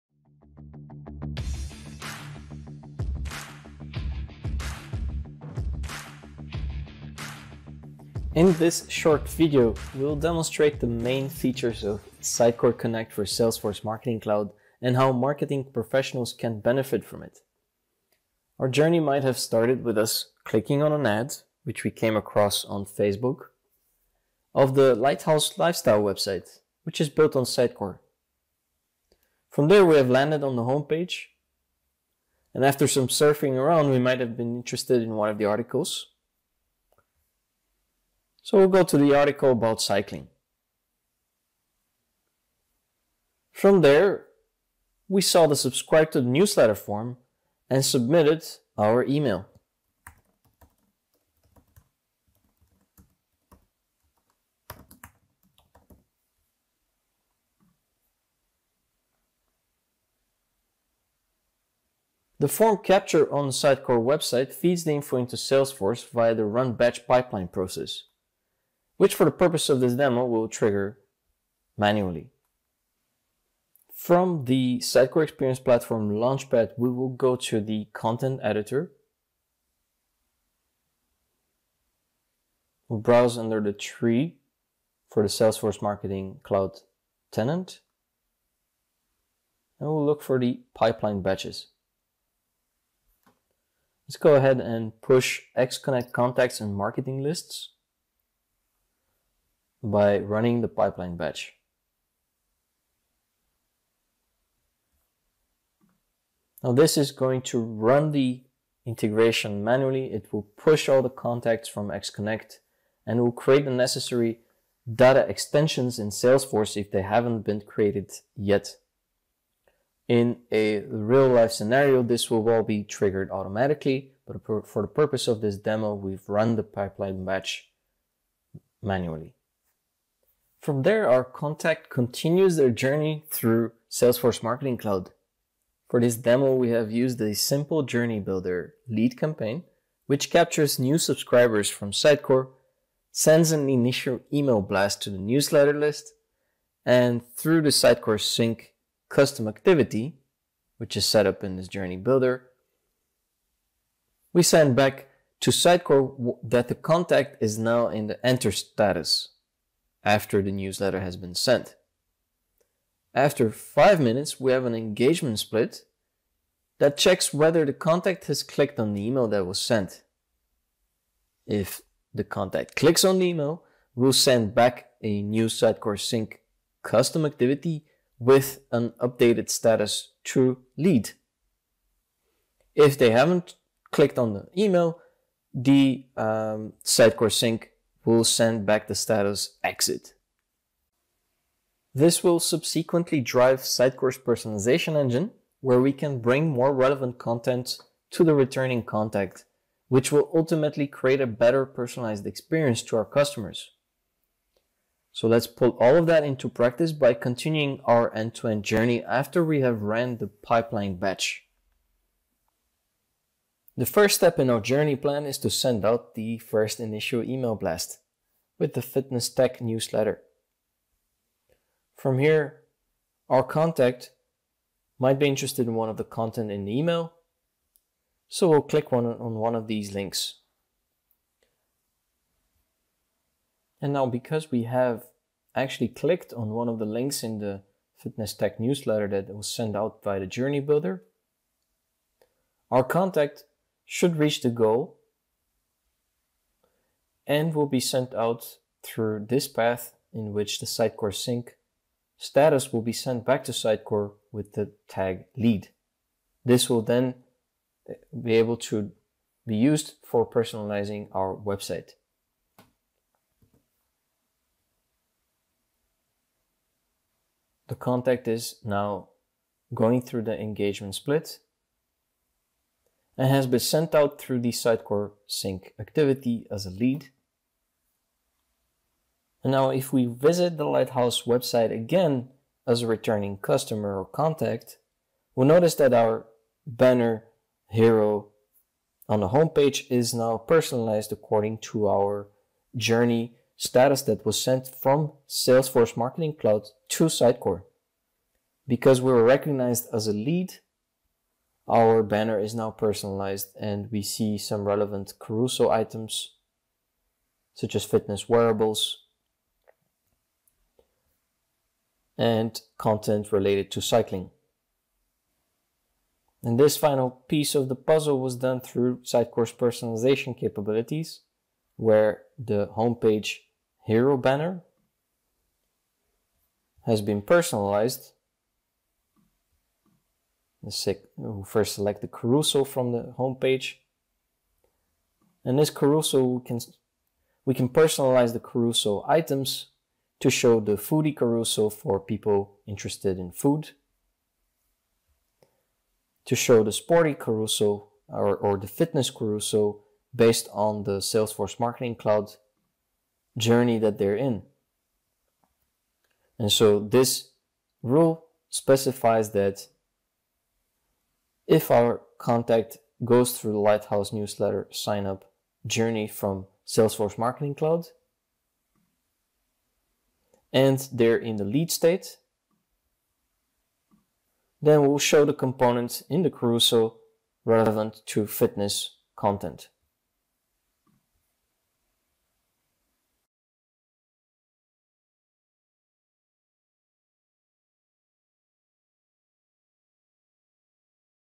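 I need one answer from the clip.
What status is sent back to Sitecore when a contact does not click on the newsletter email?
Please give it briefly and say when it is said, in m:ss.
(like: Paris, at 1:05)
Exit, at 3:09.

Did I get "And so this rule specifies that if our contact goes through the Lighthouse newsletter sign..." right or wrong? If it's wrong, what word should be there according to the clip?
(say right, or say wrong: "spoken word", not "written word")
right.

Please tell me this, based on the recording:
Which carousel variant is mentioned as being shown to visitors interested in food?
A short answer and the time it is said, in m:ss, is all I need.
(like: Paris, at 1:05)
Foodie carousel, at 5:40.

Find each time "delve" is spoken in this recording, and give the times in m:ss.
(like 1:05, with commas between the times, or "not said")
not said.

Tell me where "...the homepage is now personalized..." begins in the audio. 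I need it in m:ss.
4:49.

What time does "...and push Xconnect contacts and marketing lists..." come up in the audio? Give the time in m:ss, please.
1:34.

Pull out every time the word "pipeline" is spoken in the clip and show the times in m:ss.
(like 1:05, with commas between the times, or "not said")
1:07, 1:30, 1:40, 2:06, 3:30.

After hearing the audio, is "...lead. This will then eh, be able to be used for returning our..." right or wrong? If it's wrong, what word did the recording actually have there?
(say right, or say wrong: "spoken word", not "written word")
wrong: "personalizing", not "returning".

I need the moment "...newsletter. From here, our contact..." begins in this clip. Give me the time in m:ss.
3:39.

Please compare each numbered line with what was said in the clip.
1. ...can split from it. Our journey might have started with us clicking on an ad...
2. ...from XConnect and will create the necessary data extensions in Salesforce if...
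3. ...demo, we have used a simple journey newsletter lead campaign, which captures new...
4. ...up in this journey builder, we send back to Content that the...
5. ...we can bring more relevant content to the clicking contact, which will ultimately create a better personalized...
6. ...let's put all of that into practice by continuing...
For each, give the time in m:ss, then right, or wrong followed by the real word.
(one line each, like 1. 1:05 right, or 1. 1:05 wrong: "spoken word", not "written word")
1. 0:16 wrong: "benefit", not "split"
2. 1:51 right
3. 2:16 wrong: "builder", not "newsletter"
4. 2:31 wrong: "Sitecore", not "Content"
5. 3:15 wrong: "returning", not "clicking"
6. 3:25 right.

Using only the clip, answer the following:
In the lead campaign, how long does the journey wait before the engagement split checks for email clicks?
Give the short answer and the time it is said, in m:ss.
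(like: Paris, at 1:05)
5 minutes, at 2:43.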